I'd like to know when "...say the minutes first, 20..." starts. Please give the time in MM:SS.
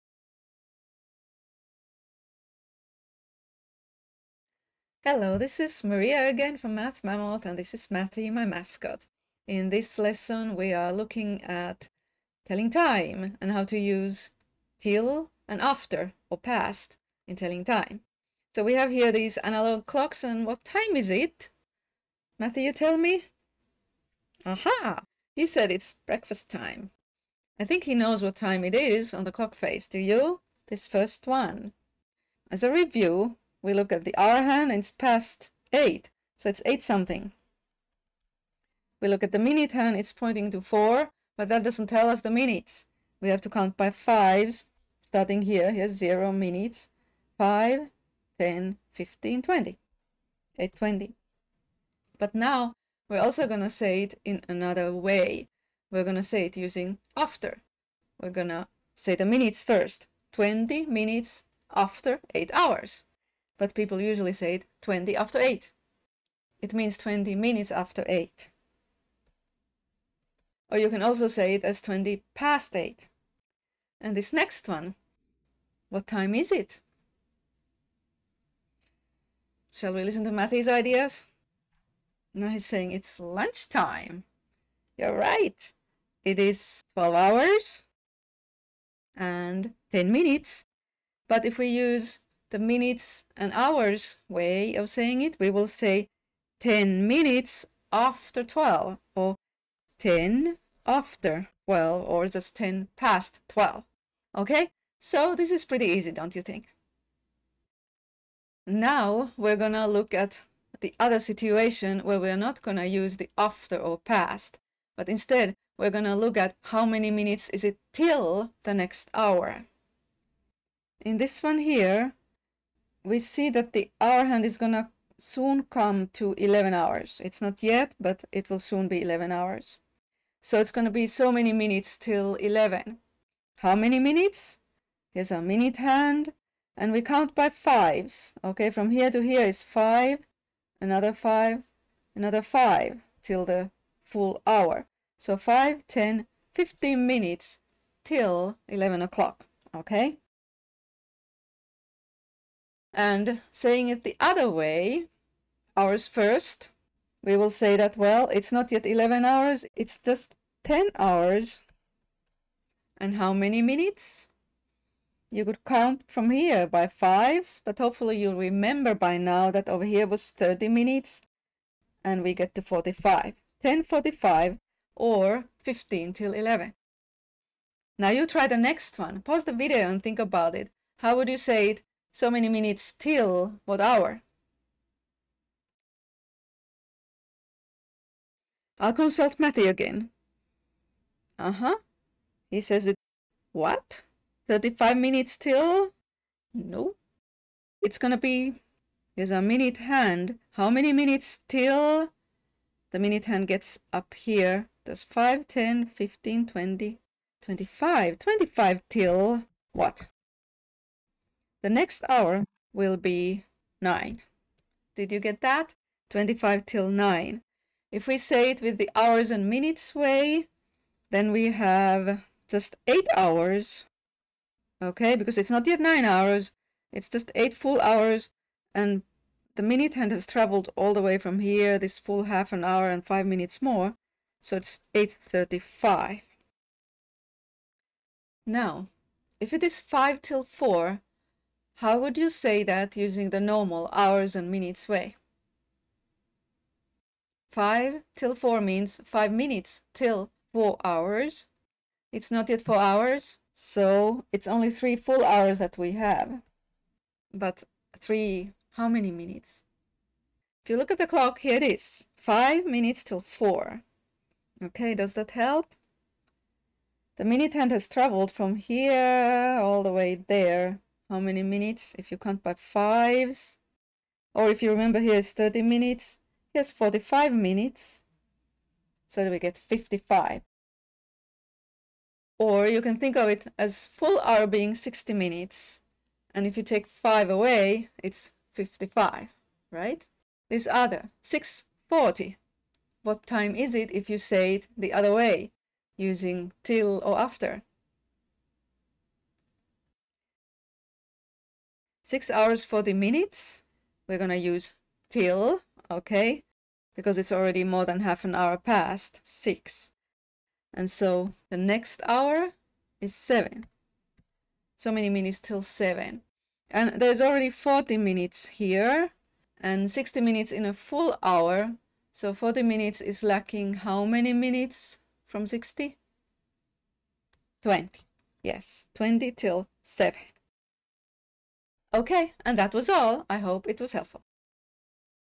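00:58.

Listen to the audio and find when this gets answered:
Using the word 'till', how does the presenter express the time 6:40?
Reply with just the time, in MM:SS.
05:28.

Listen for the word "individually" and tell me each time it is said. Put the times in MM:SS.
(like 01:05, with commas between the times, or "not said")
not said.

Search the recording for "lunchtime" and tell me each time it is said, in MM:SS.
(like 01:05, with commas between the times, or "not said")
01:23.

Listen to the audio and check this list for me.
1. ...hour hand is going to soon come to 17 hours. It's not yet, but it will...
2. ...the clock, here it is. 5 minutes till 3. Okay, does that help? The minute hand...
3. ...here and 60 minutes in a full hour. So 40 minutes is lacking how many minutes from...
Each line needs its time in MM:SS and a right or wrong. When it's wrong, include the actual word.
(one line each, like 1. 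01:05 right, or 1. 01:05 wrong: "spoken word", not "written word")
1. 02:03 wrong: "11", not "17"
2. 04:20 wrong: "4", not "3"
3. 05:18 right.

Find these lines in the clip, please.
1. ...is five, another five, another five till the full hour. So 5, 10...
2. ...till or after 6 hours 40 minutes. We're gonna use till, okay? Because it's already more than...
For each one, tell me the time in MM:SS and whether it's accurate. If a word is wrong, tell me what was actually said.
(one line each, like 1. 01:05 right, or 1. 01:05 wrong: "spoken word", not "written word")
1. 02:19 right
2. 04:56 right.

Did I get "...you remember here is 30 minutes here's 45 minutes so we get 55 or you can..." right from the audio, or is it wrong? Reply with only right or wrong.
right.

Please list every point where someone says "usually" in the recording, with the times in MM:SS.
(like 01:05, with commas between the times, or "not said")
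01:04.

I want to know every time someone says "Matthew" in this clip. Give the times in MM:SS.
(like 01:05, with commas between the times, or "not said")
00:07, 00:22, 01:20, 03:09.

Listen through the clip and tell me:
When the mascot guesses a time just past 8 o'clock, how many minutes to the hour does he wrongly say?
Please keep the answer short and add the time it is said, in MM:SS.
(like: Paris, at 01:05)
35, at 03:14.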